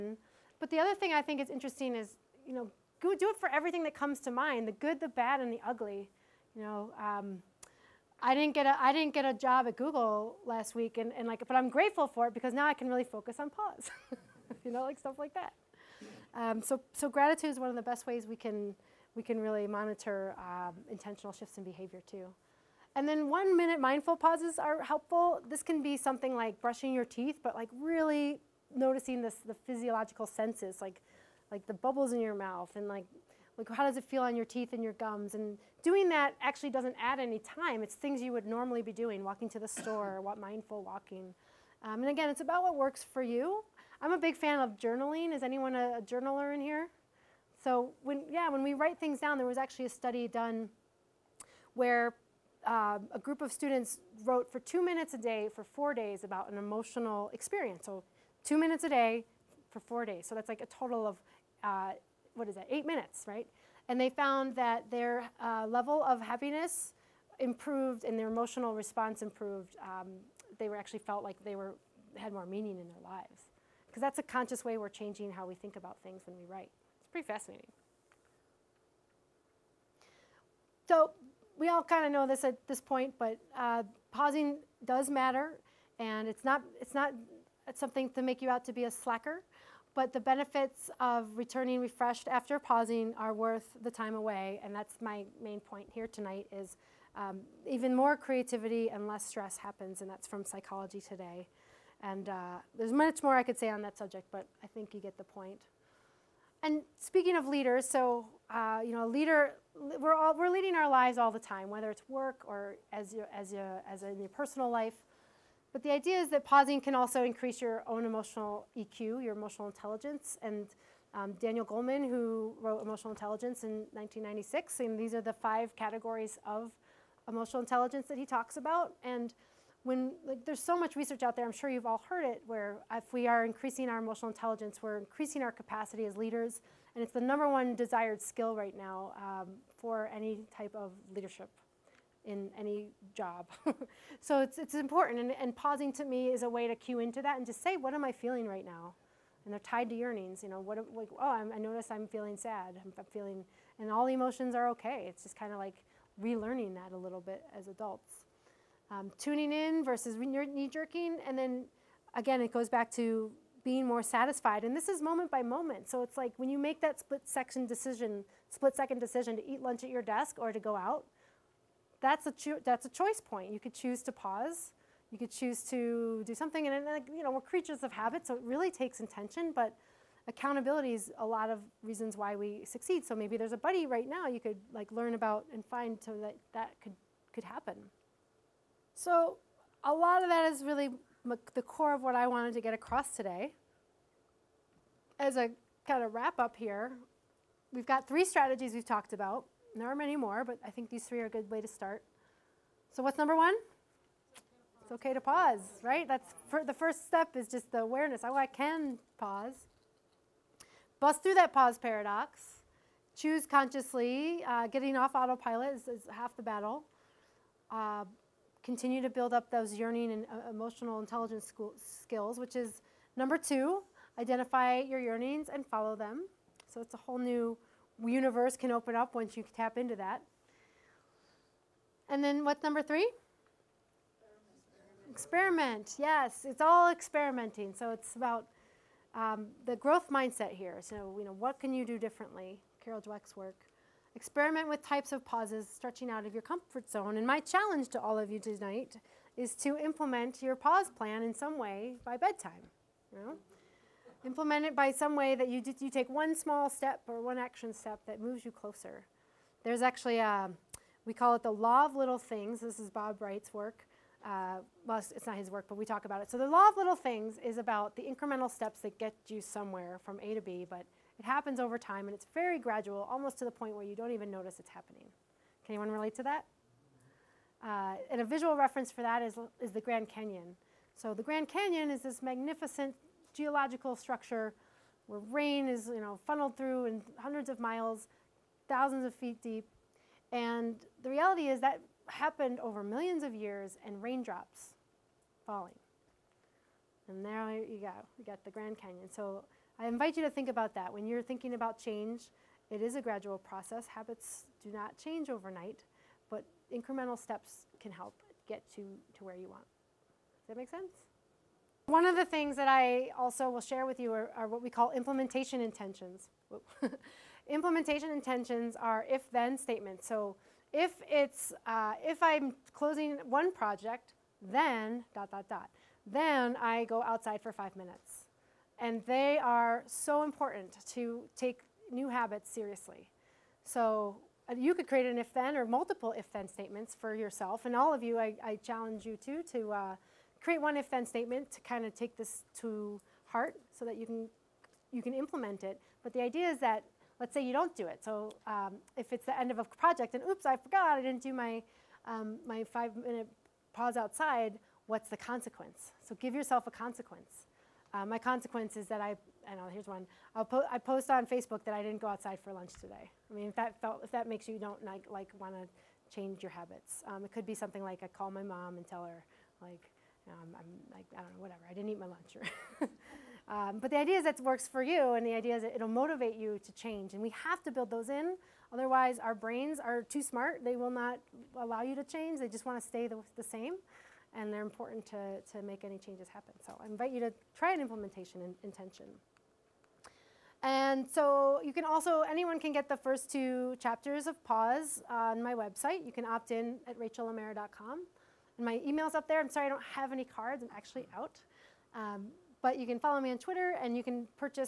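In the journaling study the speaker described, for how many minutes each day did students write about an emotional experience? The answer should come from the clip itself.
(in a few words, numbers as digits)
2.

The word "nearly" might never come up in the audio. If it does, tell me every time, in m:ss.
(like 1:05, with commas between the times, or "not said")
not said.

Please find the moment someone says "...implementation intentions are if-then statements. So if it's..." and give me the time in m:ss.
5:17.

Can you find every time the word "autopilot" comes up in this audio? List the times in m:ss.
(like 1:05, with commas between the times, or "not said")
3:35.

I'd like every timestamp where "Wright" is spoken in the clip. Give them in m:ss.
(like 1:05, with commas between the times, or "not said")
4:23.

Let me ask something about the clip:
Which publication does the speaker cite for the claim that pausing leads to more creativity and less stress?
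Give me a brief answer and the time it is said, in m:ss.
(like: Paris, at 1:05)
Psychology Today, at 1:40.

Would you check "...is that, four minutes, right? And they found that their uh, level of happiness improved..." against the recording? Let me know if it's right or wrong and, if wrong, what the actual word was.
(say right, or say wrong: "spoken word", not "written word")
wrong: "eight", not "four".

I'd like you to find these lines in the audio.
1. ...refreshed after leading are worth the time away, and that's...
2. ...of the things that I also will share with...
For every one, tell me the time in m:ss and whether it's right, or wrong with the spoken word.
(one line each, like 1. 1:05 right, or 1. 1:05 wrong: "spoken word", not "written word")
1. 1:31 wrong: "pausing", not "leading"
2. 5:12 right.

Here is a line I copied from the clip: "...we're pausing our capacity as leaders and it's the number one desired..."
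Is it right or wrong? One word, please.
wrong.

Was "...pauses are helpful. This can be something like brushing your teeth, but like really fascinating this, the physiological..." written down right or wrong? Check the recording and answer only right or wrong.
wrong.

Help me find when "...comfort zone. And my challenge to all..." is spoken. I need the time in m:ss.
4:06.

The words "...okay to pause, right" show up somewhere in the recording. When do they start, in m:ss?
3:24.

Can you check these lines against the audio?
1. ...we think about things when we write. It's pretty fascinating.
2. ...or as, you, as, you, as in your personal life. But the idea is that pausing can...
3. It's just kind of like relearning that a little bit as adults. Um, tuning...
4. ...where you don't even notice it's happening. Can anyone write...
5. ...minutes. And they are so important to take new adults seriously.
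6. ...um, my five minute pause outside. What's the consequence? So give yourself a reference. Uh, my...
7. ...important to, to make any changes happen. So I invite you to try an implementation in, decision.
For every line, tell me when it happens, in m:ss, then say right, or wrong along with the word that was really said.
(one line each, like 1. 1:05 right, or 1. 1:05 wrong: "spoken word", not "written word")
1. 1:15 right
2. 1:52 right
3. 2:35 right
4. 4:33 wrong: "relate", not "write"
5. 5:27 wrong: "habits", not "adults"
6. 5:52 wrong: "consequence", not "reference"
7. 6:24 wrong: "intention", not "decision".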